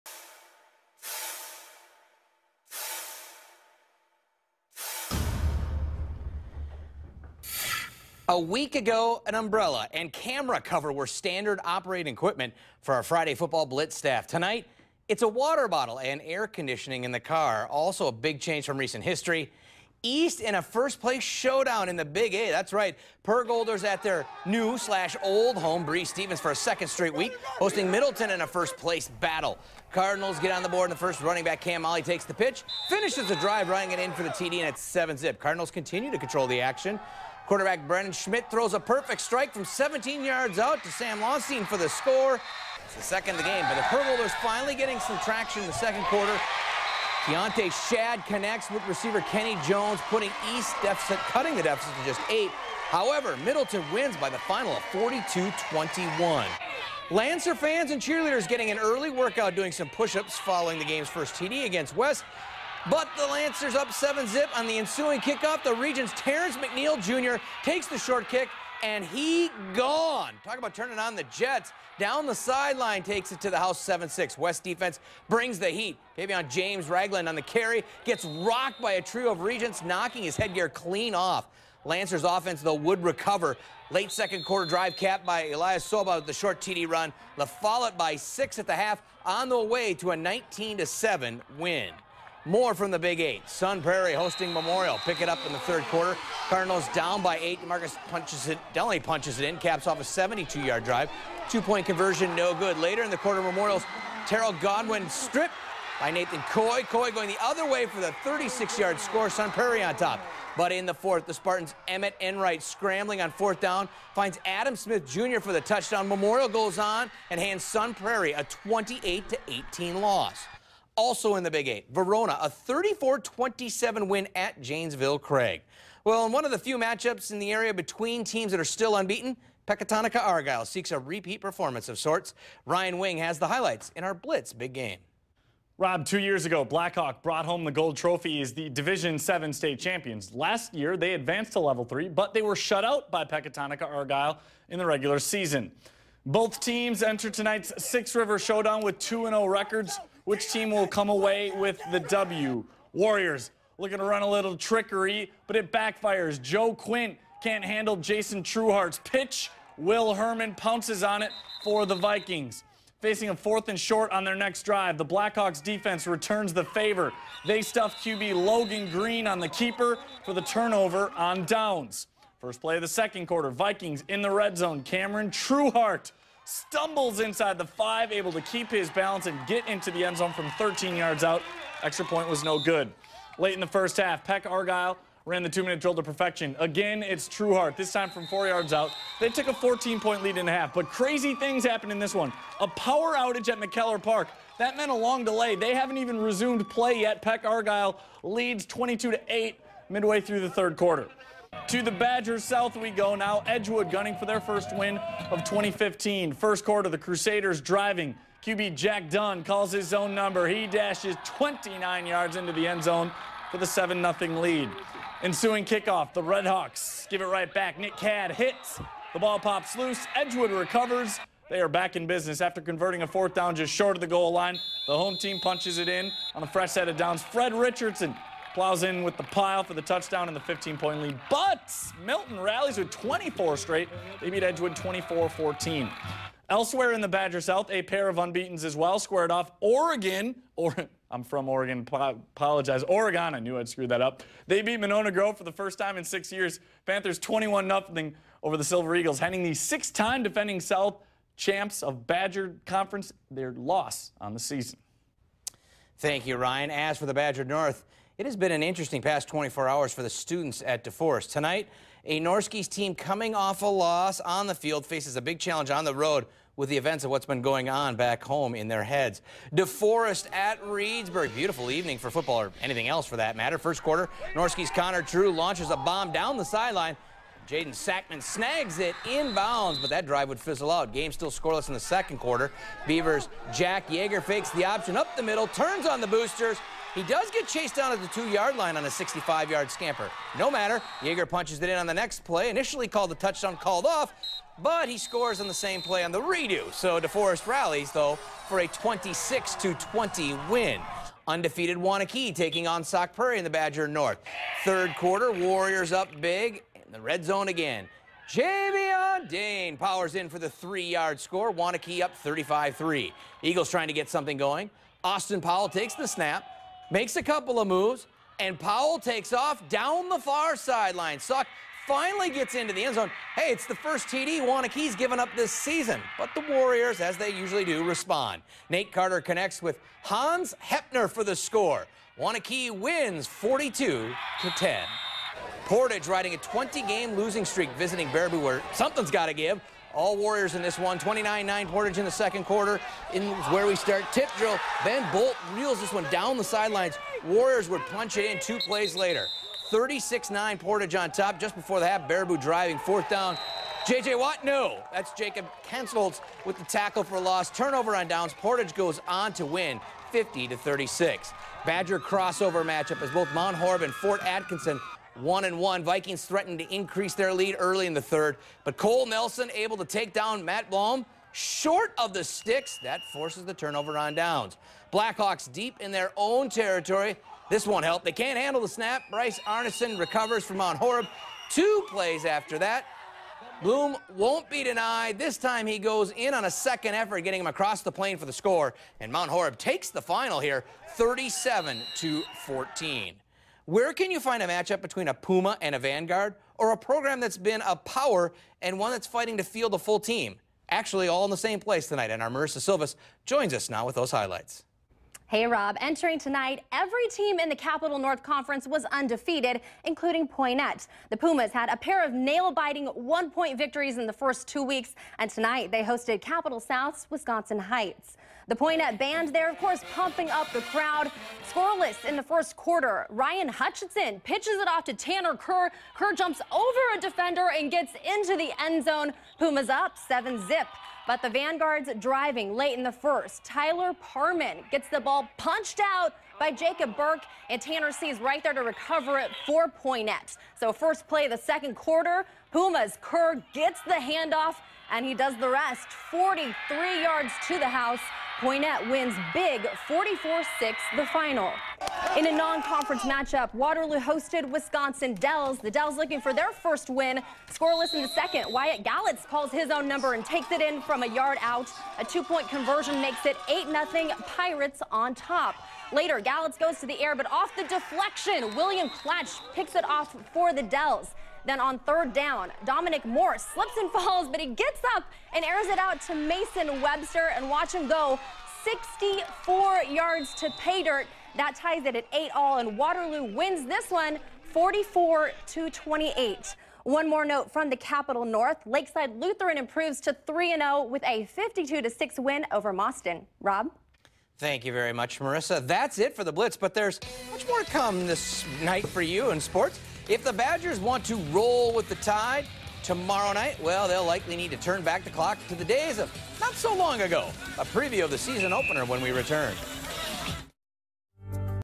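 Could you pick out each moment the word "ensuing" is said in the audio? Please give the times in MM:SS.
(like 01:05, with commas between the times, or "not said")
01:04, 03:35.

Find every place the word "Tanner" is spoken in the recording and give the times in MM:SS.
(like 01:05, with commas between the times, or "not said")
07:04, 07:17.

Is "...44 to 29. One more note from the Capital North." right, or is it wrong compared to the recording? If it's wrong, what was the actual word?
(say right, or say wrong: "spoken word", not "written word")
wrong: "28", not "29".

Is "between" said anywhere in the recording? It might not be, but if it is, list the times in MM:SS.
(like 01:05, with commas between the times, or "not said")
02:07, 06:34.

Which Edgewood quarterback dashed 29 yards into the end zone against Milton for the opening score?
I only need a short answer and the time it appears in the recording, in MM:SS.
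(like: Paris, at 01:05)
Jack Dunn, at 03:28.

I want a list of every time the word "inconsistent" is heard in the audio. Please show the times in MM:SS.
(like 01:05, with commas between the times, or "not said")
not said.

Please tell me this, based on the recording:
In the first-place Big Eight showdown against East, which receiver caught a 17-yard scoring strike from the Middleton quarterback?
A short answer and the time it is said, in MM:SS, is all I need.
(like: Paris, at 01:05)
Sam Lawson, at 00:40.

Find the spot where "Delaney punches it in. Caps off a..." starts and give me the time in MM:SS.
01:38.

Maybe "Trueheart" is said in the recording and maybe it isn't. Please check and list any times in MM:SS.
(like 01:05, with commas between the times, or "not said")
02:38, 02:55, 03:07.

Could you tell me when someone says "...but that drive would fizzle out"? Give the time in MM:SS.
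04:39.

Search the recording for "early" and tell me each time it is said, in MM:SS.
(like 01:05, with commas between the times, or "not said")
00:58, 06:07.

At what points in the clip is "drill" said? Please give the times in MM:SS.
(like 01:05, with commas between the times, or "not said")
03:05, 05:44.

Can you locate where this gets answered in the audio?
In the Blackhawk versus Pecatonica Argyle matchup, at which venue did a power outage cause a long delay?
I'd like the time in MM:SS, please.
03:13.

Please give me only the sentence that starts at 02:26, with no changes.
Both teams enter tonight's Six River Showdown with 2-0 records.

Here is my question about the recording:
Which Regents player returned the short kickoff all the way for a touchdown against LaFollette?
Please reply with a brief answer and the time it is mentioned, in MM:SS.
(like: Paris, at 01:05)
Terrence McNeil Jr., at 01:06.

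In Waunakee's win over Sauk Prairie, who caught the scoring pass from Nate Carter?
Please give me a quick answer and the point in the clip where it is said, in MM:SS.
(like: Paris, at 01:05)
Hans Hepner, at 05:30.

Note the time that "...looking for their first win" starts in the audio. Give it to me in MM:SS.
07:35.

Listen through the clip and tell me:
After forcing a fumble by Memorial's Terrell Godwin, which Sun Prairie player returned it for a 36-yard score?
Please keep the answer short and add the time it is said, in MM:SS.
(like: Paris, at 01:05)
Nathan Coy, at 01:46.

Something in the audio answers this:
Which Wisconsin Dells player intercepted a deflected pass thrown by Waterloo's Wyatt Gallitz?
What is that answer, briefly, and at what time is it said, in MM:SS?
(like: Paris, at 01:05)
William Klatch, at 07:48.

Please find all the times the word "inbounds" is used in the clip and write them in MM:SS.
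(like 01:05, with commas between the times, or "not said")
04:39.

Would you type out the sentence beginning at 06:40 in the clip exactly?
Actually, all in the same place tonight, and our Marissa Silvas joins us now with those highlights.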